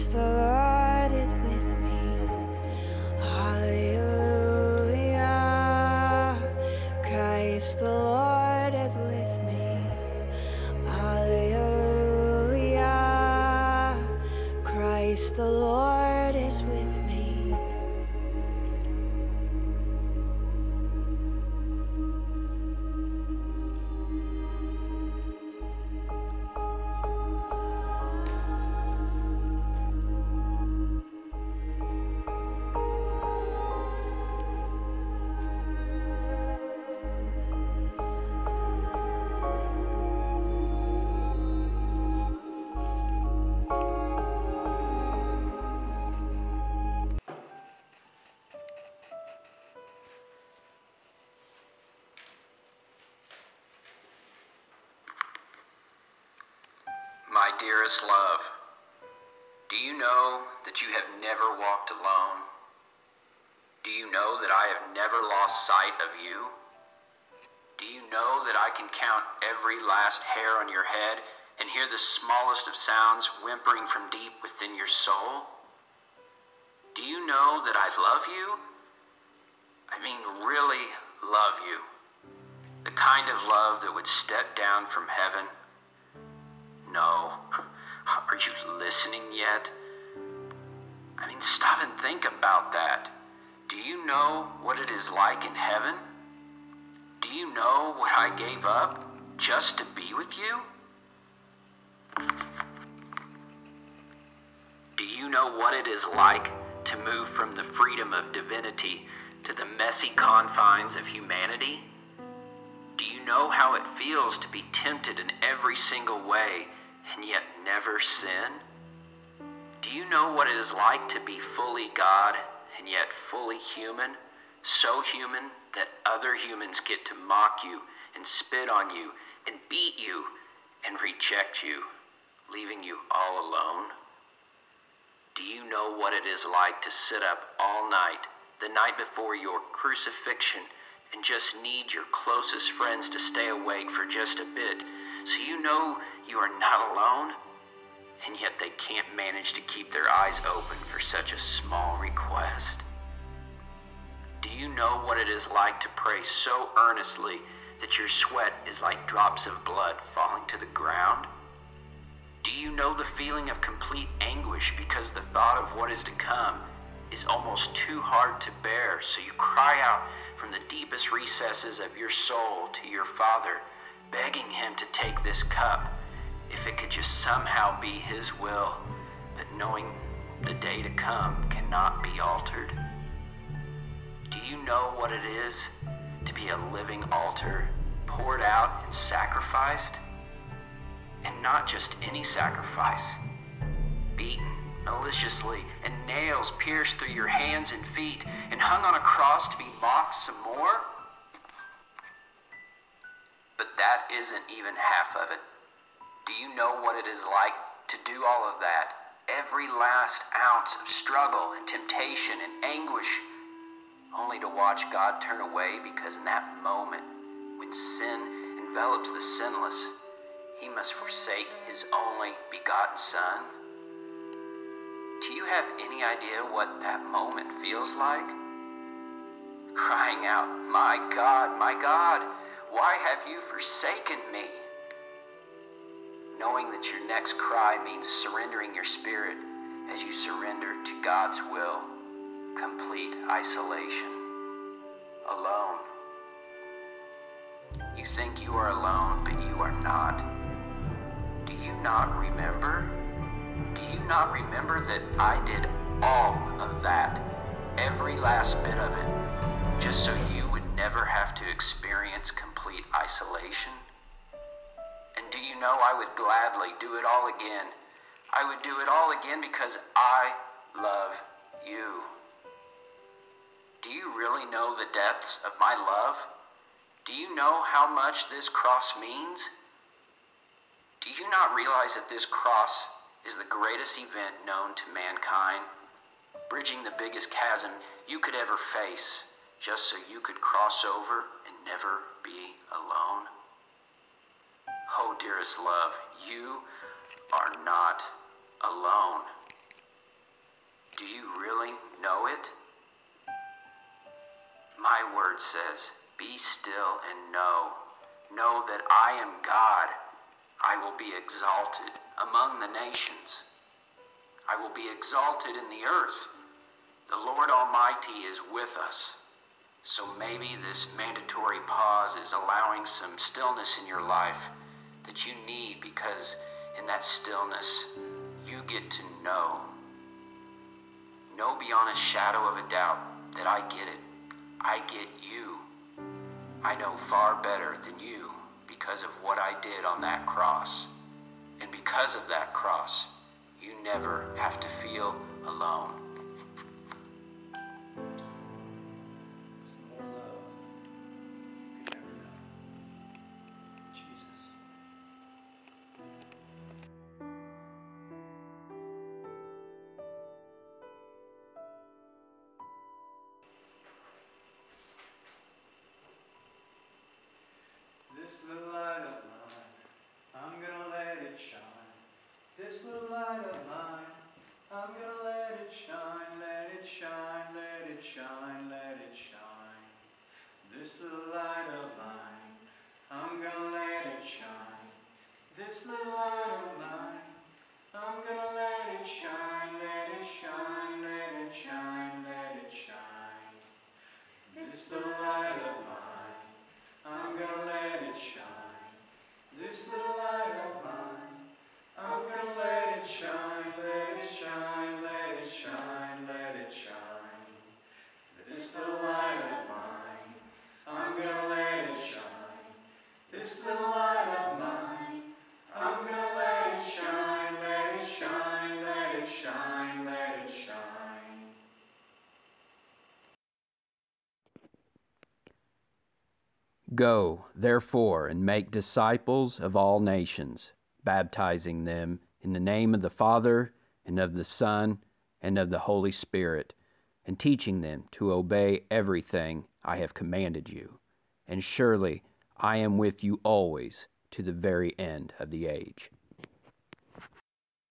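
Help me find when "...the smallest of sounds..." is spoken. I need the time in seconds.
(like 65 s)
71 s.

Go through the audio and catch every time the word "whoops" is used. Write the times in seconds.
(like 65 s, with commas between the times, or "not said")
not said.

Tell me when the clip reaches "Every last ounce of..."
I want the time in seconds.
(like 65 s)
209 s.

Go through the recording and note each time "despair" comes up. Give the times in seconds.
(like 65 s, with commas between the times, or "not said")
not said.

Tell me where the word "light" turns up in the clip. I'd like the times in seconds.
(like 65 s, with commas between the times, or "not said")
381 s, 386 s, 395 s, 400 s, 409 s, 413 s.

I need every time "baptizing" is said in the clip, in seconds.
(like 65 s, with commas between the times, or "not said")
431 s.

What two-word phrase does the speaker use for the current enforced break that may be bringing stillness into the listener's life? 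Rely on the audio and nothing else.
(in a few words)
Mandatory pause.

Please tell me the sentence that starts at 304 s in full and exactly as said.
My word says, Be still and know.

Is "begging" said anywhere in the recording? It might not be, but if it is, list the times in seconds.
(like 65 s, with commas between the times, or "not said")
174 s.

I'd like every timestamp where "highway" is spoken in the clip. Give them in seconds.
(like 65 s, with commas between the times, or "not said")
not said.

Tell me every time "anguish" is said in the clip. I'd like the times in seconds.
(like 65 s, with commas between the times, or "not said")
164 s, 212 s.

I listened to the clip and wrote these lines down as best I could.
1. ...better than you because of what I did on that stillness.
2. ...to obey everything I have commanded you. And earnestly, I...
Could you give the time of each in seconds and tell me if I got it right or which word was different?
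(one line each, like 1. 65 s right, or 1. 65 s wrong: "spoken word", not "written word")
1. 337 s wrong: "cross", not "stillness"
2. 438 s wrong: "surely", not "earnestly".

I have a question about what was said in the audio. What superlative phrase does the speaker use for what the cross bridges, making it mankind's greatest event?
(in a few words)
The biggest chasm.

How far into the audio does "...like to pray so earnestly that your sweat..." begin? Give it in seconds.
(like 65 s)
155 s.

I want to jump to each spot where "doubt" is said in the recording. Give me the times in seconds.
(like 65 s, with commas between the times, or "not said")
332 s.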